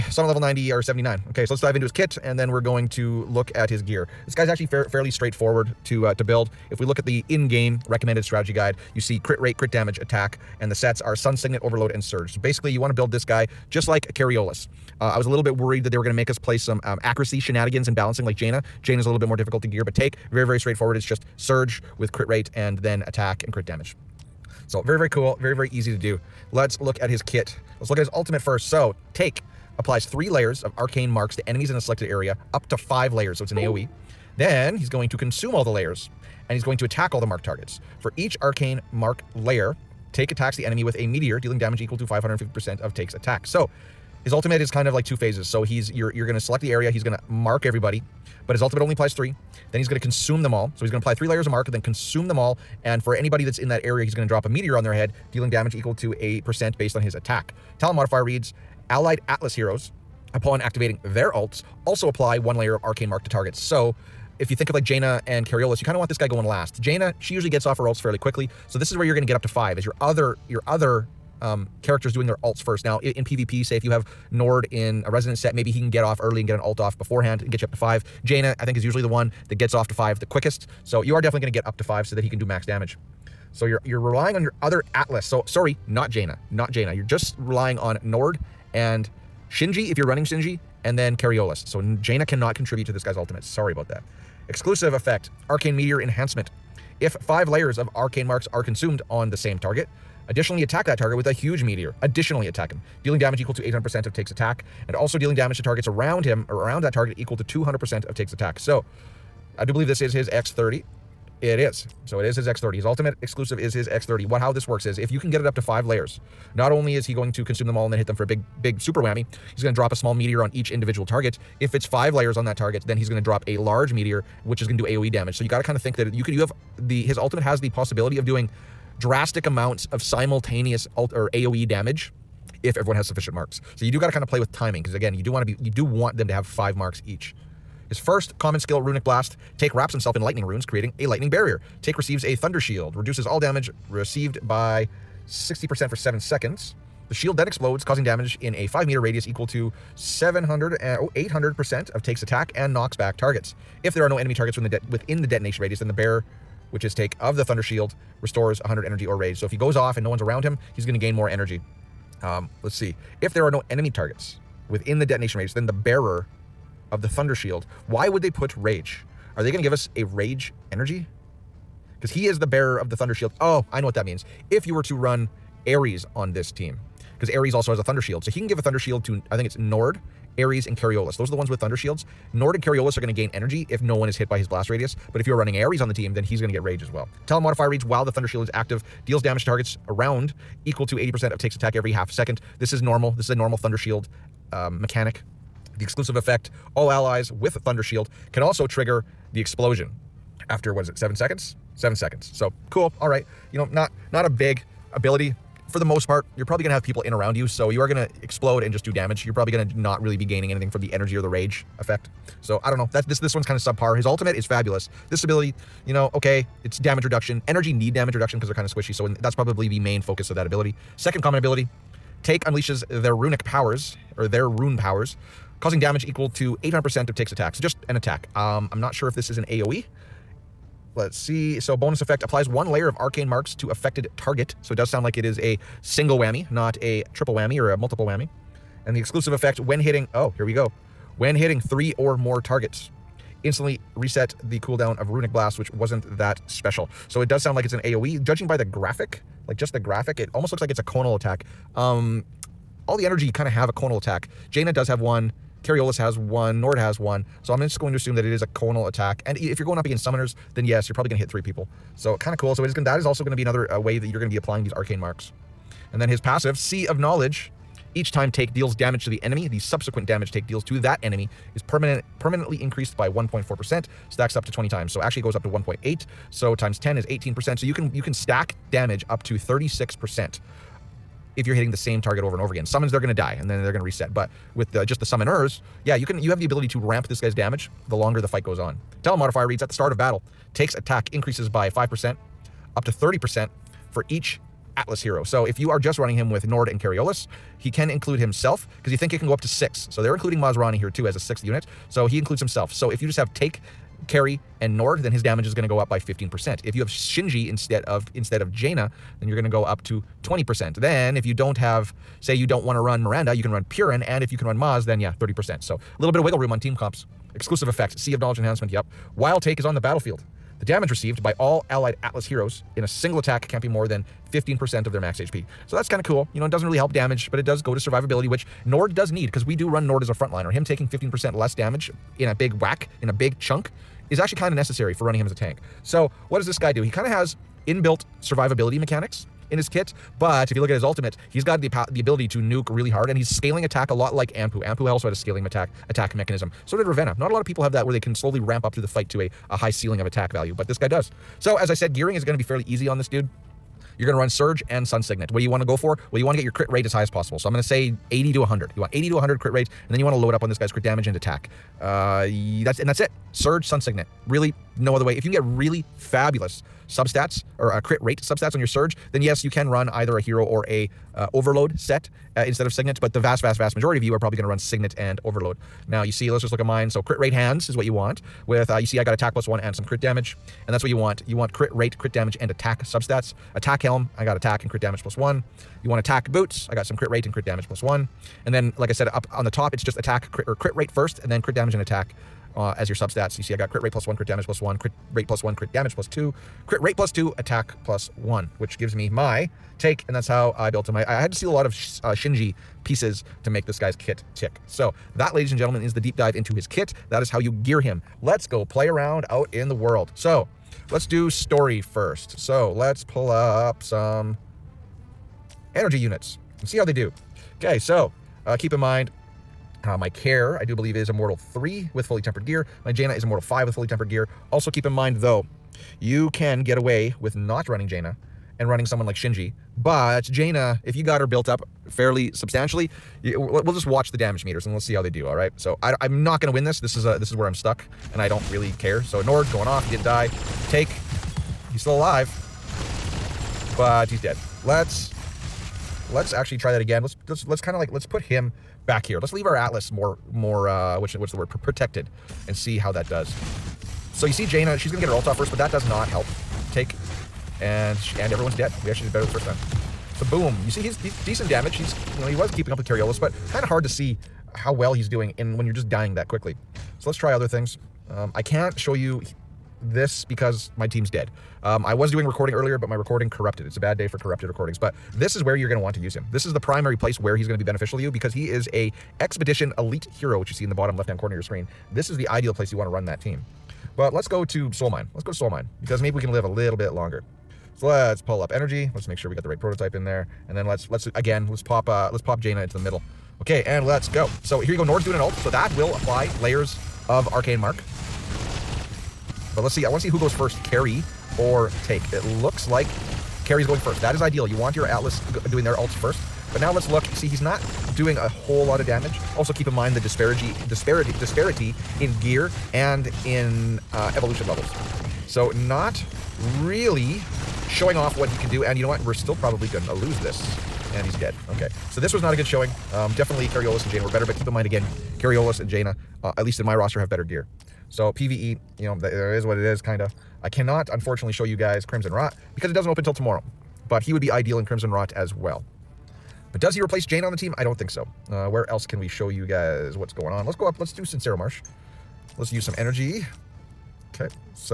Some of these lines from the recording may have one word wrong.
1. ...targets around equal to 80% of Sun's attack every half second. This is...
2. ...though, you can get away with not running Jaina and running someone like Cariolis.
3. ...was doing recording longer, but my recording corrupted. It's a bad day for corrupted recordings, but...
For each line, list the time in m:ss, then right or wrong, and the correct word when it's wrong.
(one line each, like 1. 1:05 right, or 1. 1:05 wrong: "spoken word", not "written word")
1. 3:09 wrong: "Taec", not "Sun"
2. 7:05 wrong: "Shinji", not "Cariolis"
3. 7:51 wrong: "earlier", not "longer".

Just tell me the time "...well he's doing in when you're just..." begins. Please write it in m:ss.
7:44.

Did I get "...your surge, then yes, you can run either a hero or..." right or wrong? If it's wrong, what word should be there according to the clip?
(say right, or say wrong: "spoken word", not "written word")
right.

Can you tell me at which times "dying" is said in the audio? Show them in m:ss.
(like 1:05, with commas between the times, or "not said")
7:45.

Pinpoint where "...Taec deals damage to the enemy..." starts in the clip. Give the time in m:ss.
4:28.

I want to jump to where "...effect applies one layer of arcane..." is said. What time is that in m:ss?
3:52.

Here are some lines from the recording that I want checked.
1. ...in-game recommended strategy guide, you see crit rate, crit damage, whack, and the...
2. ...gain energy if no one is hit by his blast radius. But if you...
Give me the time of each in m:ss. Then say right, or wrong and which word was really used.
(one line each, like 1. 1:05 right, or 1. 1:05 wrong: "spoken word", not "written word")
1. 0:07 wrong: "attack", not "whack"
2. 3:03 right.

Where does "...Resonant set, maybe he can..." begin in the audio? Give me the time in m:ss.
1:15.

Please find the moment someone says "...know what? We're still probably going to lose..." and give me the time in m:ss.
8:38.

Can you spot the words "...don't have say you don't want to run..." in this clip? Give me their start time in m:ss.
5:11.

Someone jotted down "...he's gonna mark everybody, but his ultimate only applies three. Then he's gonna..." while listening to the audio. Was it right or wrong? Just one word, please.
right.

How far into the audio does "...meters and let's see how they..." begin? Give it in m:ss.
7:14.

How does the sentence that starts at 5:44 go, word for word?
Anpu also had a scaling attack attack mechanism.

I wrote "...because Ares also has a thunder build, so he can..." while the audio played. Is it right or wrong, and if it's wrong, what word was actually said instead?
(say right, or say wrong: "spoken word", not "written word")
wrong: "shield", not "build".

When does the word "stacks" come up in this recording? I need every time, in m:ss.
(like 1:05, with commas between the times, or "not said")
4:34, 4:38.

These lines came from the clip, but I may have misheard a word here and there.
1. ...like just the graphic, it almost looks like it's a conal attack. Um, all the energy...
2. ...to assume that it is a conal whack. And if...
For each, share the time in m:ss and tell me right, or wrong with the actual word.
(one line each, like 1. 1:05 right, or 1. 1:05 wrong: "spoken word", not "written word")
1. 4:09 right
2. 4:17 wrong: "attack", not "whack".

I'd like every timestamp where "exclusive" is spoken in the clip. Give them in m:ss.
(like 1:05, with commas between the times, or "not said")
1:34, 1:53, 3:15, 3:58, 5:17.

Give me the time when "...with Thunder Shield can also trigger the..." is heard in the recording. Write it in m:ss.
3:17.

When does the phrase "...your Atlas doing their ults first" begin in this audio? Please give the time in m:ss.
8:24.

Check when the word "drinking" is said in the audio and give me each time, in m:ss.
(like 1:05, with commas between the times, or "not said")
not said.